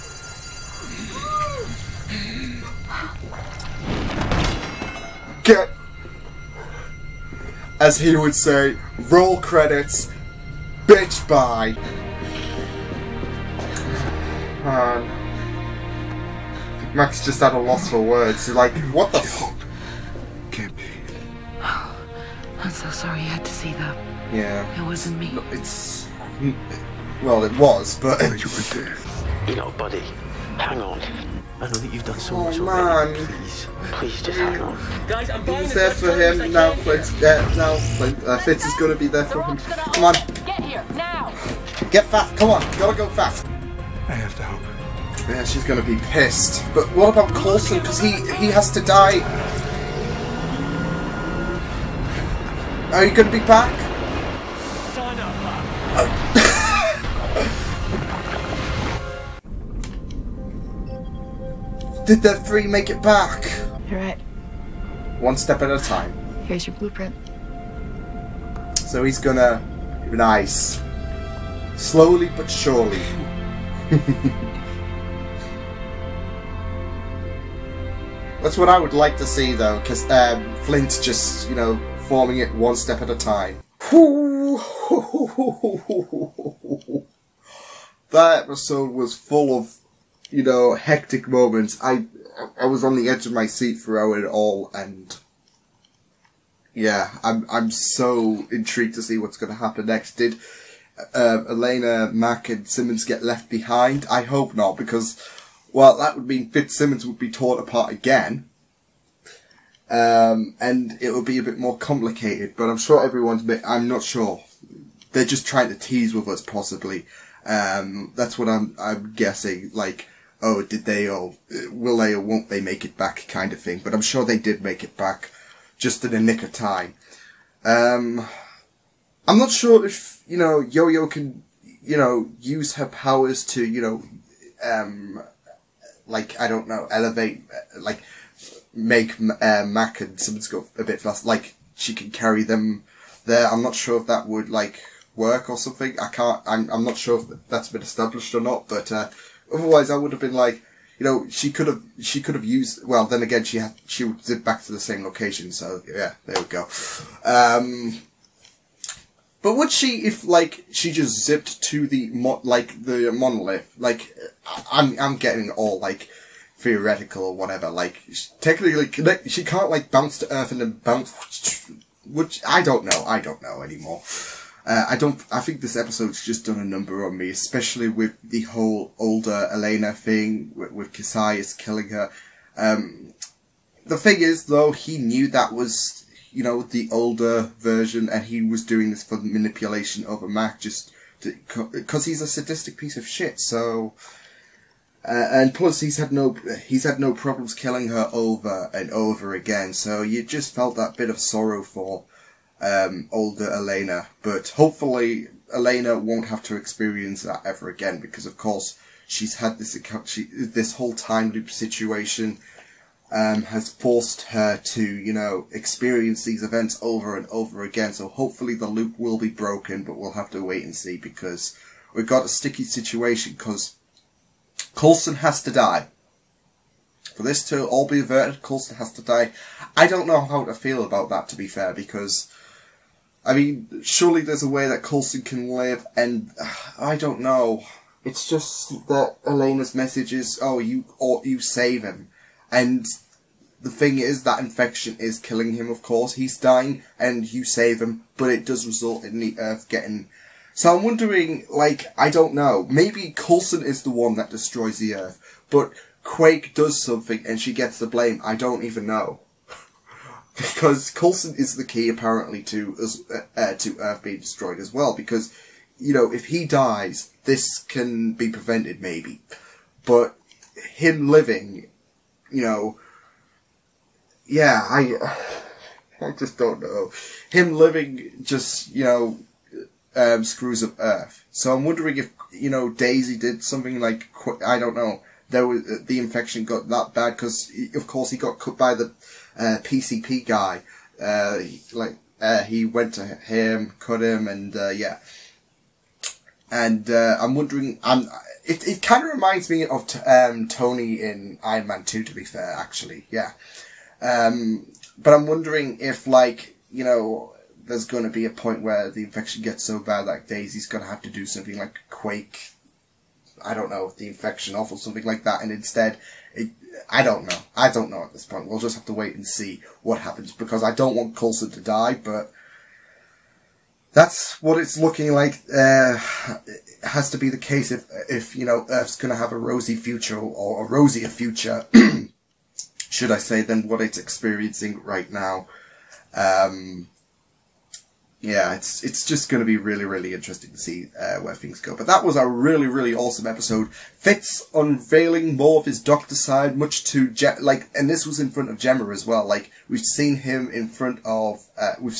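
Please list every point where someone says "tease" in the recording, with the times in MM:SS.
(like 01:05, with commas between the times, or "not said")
01:55.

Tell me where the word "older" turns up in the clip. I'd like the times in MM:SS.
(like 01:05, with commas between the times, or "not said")
02:58, 03:06, 03:23.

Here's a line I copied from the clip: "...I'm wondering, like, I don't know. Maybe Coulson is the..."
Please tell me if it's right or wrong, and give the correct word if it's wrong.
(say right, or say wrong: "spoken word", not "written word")
right.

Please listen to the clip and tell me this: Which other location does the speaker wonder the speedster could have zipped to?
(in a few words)
the monolith.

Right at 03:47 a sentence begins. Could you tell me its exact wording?
For this to all be averted, Coulson has to die.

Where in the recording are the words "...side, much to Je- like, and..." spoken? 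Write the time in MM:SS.
05:46.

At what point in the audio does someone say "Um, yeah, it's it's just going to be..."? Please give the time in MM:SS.
05:36.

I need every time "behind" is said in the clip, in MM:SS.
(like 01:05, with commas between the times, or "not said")
01:43.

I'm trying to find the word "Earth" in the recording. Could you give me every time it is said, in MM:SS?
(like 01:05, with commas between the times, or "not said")
02:50, 04:09, 04:14, 04:23, 04:40, 05:28.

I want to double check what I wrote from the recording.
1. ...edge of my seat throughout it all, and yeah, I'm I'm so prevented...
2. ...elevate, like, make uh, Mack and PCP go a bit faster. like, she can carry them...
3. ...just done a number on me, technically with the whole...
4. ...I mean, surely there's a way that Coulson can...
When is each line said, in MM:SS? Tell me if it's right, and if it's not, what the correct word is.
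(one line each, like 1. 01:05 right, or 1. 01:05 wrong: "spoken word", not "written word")
1. 01:33 wrong: "intrigued", not "prevented"
2. 02:16 wrong: "Simmons", not "PCP"
3. 02:56 wrong: "especially", not "technically"
4. 03:53 right.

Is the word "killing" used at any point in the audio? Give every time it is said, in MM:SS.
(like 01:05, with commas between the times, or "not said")
03:01, 03:17, 04:05.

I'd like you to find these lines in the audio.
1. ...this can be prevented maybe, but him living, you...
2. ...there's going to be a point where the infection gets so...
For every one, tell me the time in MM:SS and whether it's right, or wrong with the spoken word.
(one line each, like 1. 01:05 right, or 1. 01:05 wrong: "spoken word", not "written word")
1. 04:27 right
2. 05:07 right.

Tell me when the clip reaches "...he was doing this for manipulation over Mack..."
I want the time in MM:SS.
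03:08.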